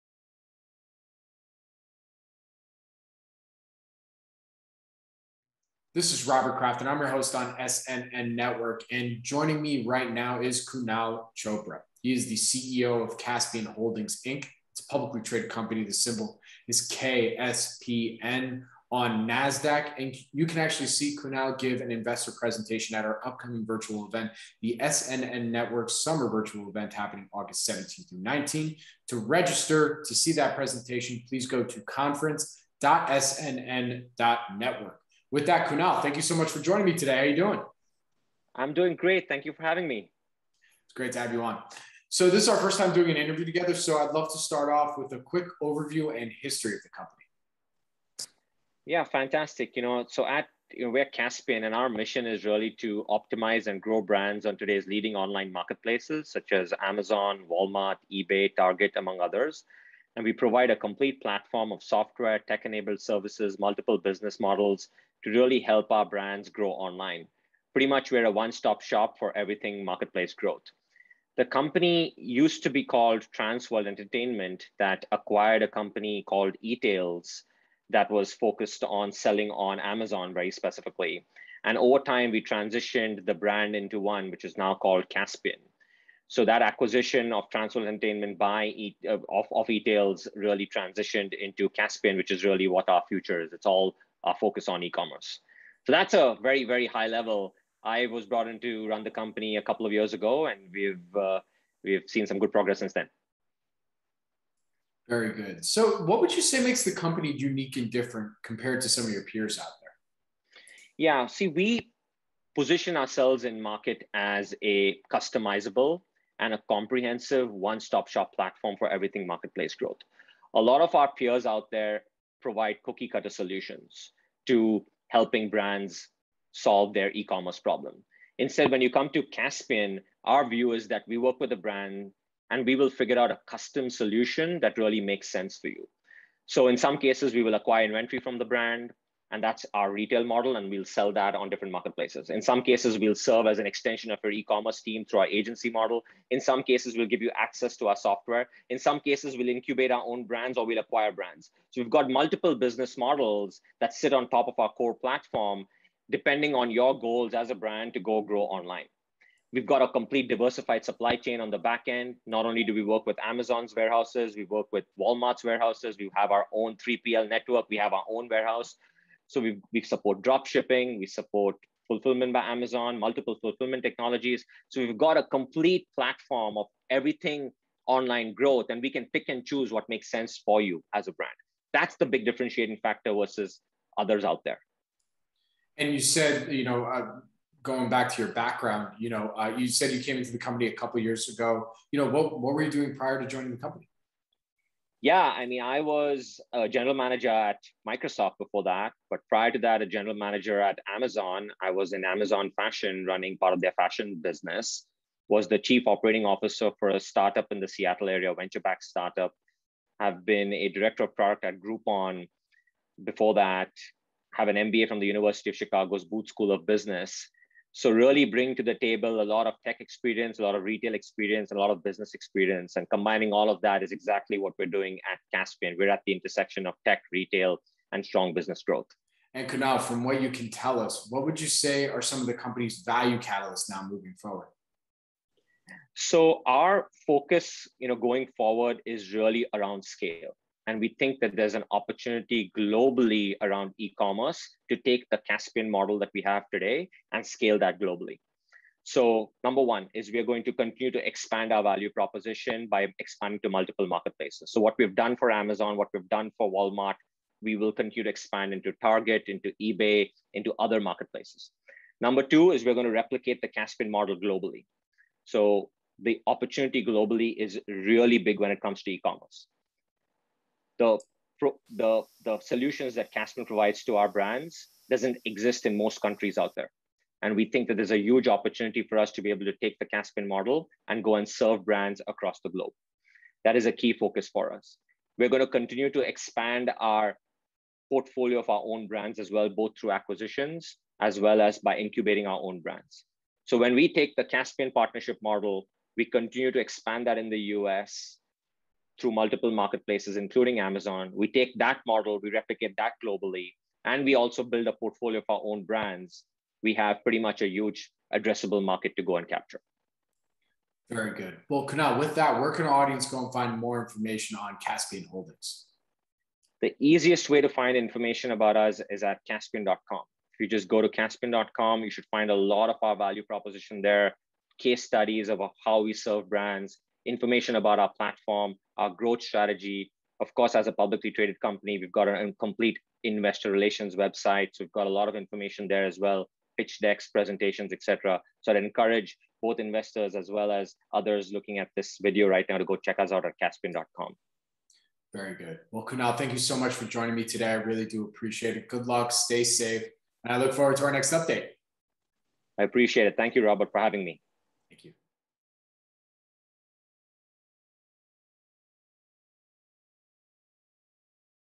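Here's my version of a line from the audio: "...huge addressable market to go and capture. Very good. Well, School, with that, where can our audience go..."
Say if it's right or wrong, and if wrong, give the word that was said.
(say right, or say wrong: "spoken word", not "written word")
wrong: "Kunal", not "School".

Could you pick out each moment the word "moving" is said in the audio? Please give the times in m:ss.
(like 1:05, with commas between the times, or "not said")
3:53.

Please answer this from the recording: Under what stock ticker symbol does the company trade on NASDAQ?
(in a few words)
KSPN.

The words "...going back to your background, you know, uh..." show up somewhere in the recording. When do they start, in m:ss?
3:07.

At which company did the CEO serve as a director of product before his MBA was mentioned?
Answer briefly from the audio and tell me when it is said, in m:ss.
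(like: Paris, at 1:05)
Groupon, at 3:31.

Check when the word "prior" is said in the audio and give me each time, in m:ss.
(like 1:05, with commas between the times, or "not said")
3:12, 3:19.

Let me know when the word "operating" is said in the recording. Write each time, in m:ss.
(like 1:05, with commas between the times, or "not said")
3:25.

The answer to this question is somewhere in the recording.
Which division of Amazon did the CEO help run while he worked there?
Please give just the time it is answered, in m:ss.
3:22.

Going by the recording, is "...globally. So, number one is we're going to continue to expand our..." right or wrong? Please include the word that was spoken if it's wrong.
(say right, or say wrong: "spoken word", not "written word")
right.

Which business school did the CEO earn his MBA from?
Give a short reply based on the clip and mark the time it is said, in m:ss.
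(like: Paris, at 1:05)
University of Chicago's Booth School of Business, at 3:35.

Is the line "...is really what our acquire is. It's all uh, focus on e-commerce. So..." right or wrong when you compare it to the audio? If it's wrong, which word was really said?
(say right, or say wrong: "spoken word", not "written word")
wrong: "future", not "acquire".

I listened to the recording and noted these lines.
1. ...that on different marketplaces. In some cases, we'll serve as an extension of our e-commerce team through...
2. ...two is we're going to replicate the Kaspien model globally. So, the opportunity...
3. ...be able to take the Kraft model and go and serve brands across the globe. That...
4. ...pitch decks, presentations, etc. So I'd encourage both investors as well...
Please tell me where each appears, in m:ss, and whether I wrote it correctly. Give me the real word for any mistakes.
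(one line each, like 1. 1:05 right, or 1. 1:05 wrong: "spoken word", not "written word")
1. 2:21 right
2. 4:22 right
3. 4:39 wrong: "Kaspien", not "Kraft"
4. 5:36 right.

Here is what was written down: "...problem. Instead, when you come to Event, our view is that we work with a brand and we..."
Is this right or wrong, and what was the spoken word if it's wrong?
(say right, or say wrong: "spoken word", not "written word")
wrong: "Kaspien", not "Event".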